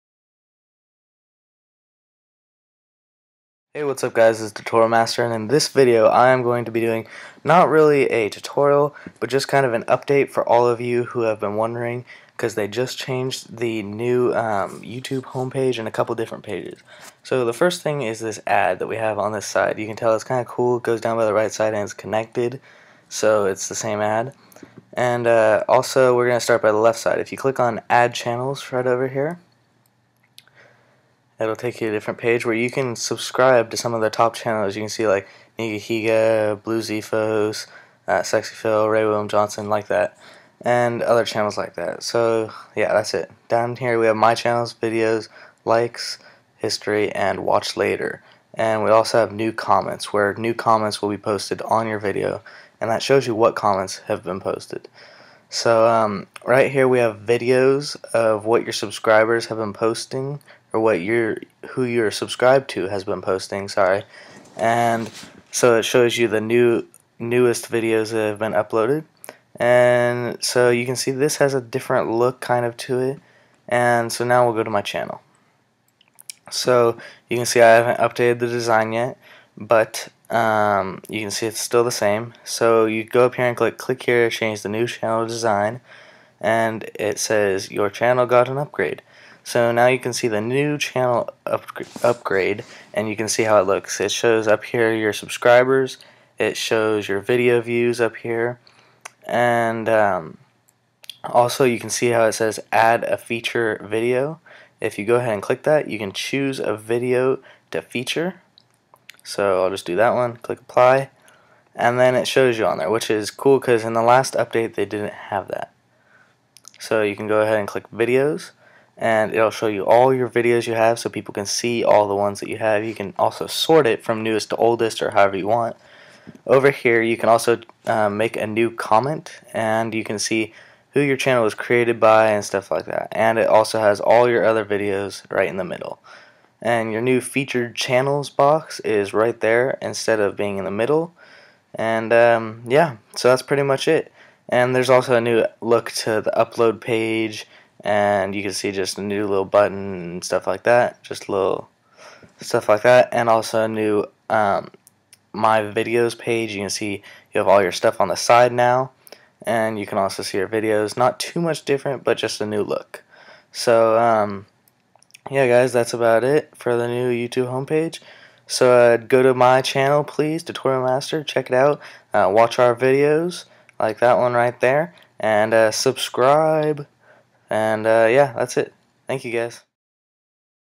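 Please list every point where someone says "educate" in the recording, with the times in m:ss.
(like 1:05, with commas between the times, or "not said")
not said.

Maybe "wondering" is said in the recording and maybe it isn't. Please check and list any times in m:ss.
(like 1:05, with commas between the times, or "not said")
0:11.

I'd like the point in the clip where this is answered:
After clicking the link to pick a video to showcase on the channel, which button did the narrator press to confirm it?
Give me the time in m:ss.
1:50.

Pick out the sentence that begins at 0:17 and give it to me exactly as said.
So the first thing is this ad that we have on this side.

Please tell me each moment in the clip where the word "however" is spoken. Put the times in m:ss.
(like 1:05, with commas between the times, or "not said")
2:05.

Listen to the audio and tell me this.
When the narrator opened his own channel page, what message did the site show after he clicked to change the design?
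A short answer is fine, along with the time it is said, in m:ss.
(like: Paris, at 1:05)
your channel got an upgrade, at 1:27.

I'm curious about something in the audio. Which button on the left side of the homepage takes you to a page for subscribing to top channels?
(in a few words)
add channels.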